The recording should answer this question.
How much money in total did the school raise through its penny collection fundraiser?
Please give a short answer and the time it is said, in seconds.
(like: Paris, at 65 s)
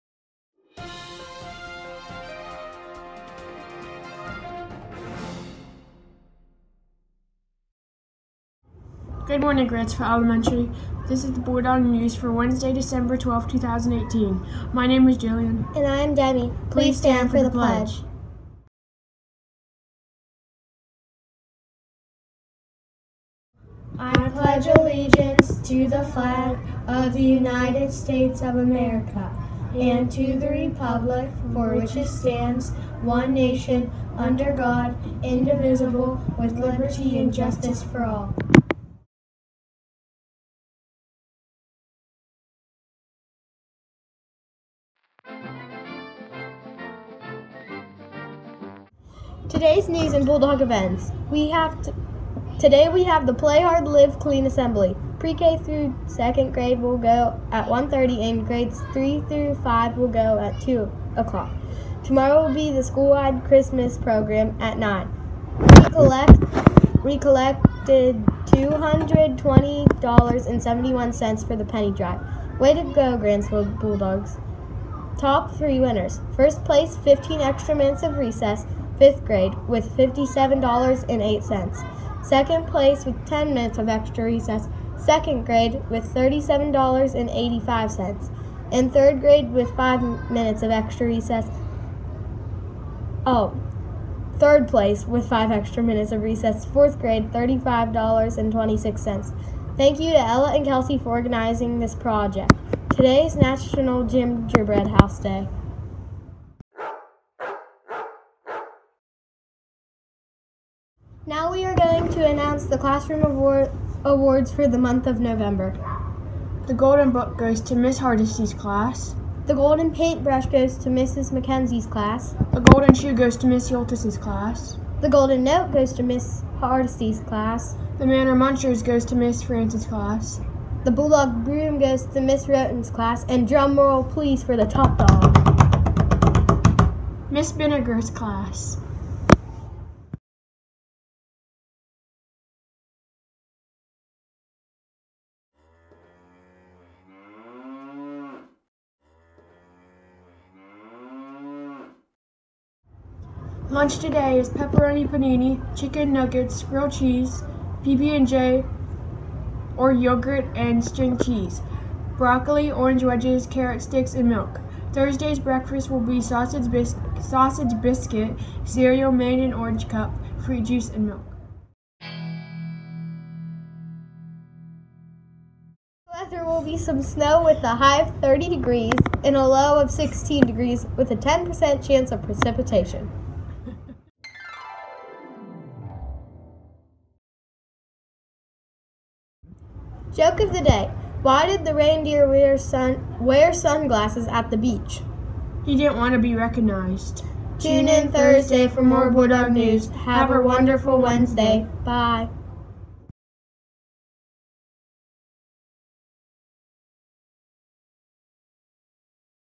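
$220.71, at 68 s.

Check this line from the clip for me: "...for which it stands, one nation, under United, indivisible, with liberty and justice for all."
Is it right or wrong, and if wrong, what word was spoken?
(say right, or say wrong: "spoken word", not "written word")
wrong: "God", not "United".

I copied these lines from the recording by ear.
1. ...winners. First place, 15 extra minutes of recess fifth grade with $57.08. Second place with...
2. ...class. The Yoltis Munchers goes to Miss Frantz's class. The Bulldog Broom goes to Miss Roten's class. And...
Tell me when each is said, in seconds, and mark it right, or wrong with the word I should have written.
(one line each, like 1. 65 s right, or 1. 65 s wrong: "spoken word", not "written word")
1. 75 s right
2. 127 s wrong: "Manor", not "Yoltis".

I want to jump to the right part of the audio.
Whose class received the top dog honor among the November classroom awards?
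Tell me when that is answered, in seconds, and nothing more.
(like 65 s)
137 s.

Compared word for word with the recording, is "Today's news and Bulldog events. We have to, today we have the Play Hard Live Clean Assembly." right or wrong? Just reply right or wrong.
right.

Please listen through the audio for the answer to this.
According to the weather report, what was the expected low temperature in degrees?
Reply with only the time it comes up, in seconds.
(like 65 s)
179 s.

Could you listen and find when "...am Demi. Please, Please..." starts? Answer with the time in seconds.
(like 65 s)
16 s.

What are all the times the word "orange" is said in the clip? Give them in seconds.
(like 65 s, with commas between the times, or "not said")
162 s, 169 s.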